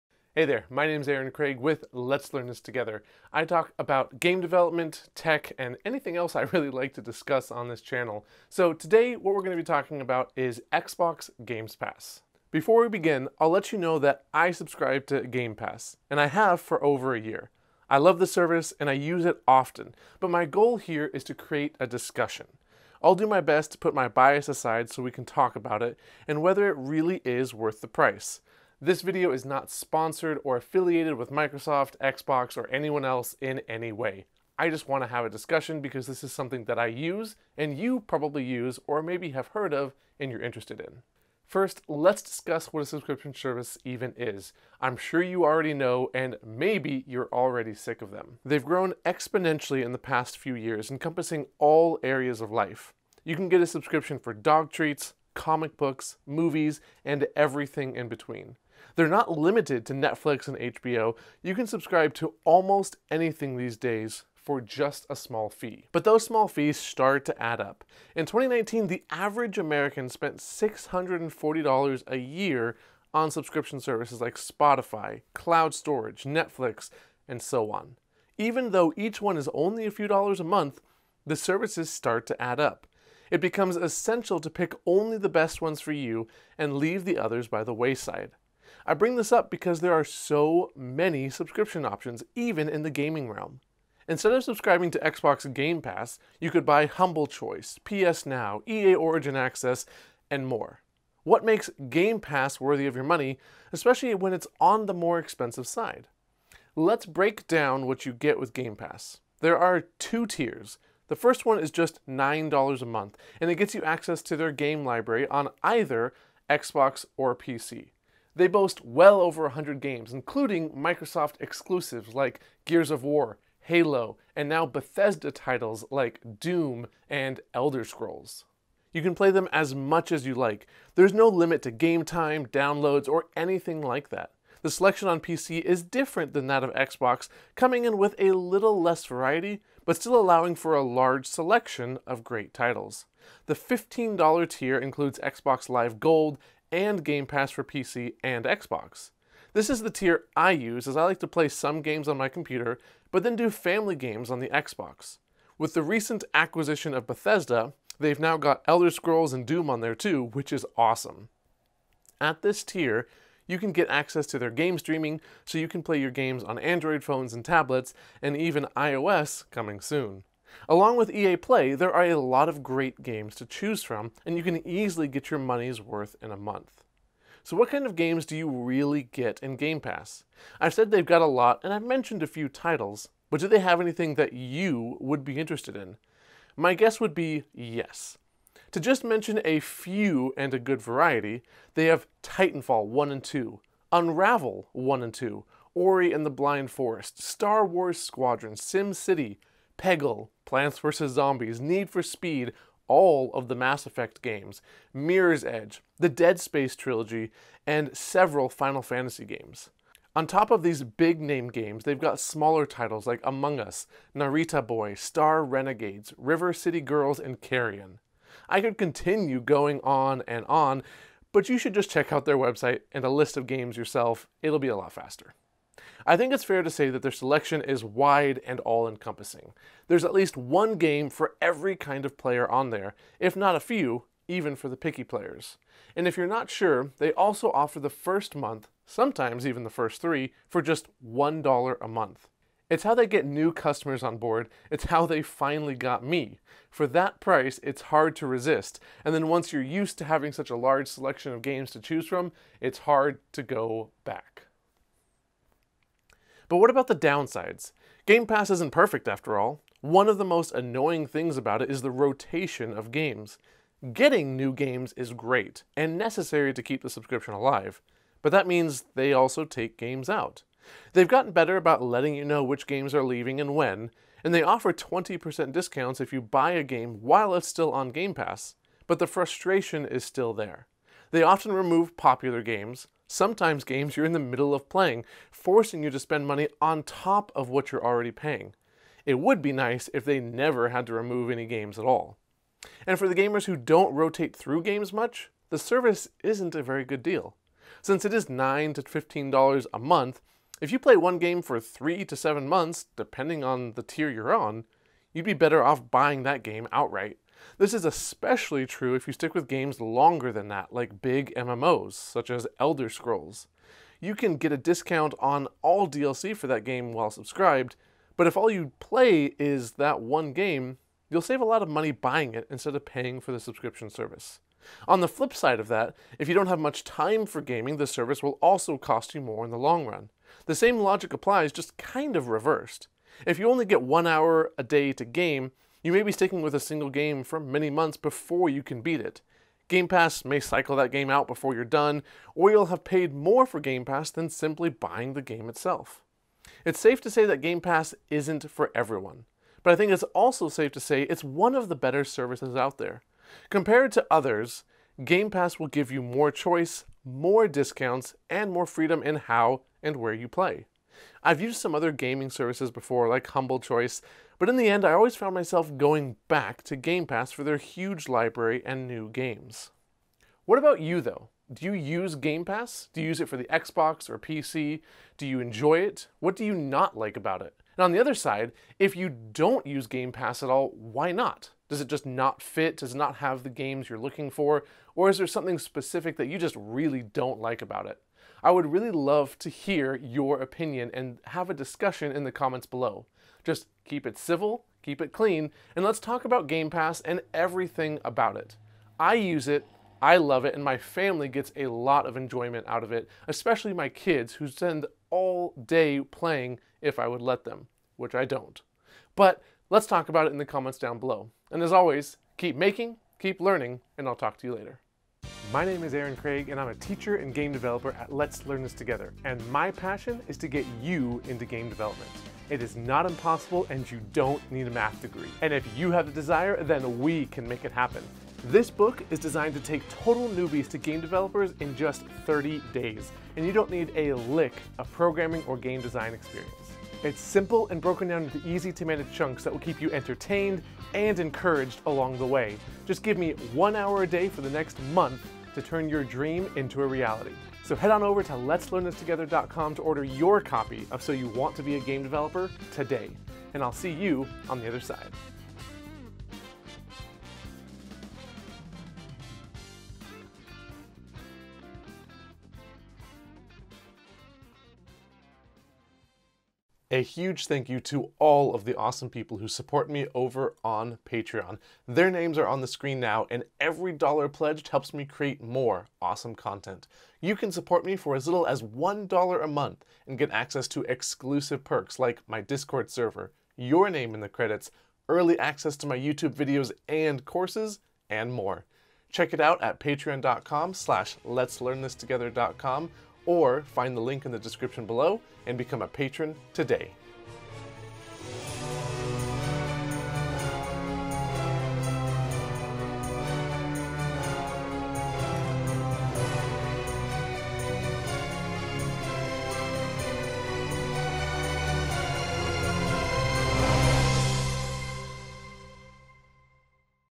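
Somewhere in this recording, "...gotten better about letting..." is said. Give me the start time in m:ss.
4:31.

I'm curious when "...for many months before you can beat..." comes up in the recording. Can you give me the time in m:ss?
5:37.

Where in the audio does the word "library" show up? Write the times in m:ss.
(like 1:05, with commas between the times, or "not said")
1:54, 6:08.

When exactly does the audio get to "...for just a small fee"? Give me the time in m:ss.
1:04.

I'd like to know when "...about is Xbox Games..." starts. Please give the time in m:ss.
0:09.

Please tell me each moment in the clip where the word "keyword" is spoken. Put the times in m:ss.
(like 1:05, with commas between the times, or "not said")
not said.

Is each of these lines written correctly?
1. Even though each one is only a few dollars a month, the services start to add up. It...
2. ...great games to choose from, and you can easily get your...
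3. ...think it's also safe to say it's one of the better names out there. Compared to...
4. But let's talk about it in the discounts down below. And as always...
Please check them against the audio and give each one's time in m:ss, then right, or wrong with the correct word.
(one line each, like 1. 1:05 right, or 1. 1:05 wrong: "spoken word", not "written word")
1. 1:18 right
2. 2:52 right
3. 5:49 wrong: "services", not "names"
4. 6:49 wrong: "comments", not "discounts".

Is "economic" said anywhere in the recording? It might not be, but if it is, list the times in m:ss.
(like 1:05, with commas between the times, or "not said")
not said.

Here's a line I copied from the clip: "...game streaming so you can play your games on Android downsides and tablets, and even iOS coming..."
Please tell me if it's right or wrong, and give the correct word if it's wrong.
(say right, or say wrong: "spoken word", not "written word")
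wrong: "phones", not "downsides".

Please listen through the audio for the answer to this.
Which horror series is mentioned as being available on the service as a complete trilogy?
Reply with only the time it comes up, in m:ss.
3:25.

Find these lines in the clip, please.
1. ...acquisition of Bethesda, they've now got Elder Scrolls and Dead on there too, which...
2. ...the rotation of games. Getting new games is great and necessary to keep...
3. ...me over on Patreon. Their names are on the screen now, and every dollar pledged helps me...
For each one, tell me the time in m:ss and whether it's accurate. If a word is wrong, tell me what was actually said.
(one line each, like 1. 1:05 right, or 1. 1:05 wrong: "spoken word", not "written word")
1. 2:36 wrong: "Doom", not "Dead"
2. 4:21 right
3. 7:49 right.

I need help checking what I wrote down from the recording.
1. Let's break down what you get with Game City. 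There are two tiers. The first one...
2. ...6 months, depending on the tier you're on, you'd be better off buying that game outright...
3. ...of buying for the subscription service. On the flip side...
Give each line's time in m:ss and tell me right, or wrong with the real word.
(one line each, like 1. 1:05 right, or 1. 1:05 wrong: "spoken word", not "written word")
1. 1:46 wrong: "Pass", not "City"
2. 5:02 wrong: "7", not "6"
3. 5:22 wrong: "paying", not "buying".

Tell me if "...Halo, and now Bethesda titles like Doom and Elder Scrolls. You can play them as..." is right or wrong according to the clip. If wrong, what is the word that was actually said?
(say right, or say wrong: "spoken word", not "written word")
right.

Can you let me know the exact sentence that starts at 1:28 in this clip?
I bring this up because there are so many subscription options, even in the gaming realm.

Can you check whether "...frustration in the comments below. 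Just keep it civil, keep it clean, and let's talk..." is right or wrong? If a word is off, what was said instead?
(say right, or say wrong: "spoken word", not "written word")
wrong: "discussion", not "frustration".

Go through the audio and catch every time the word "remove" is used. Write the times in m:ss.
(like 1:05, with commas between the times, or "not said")
4:41, 4:50.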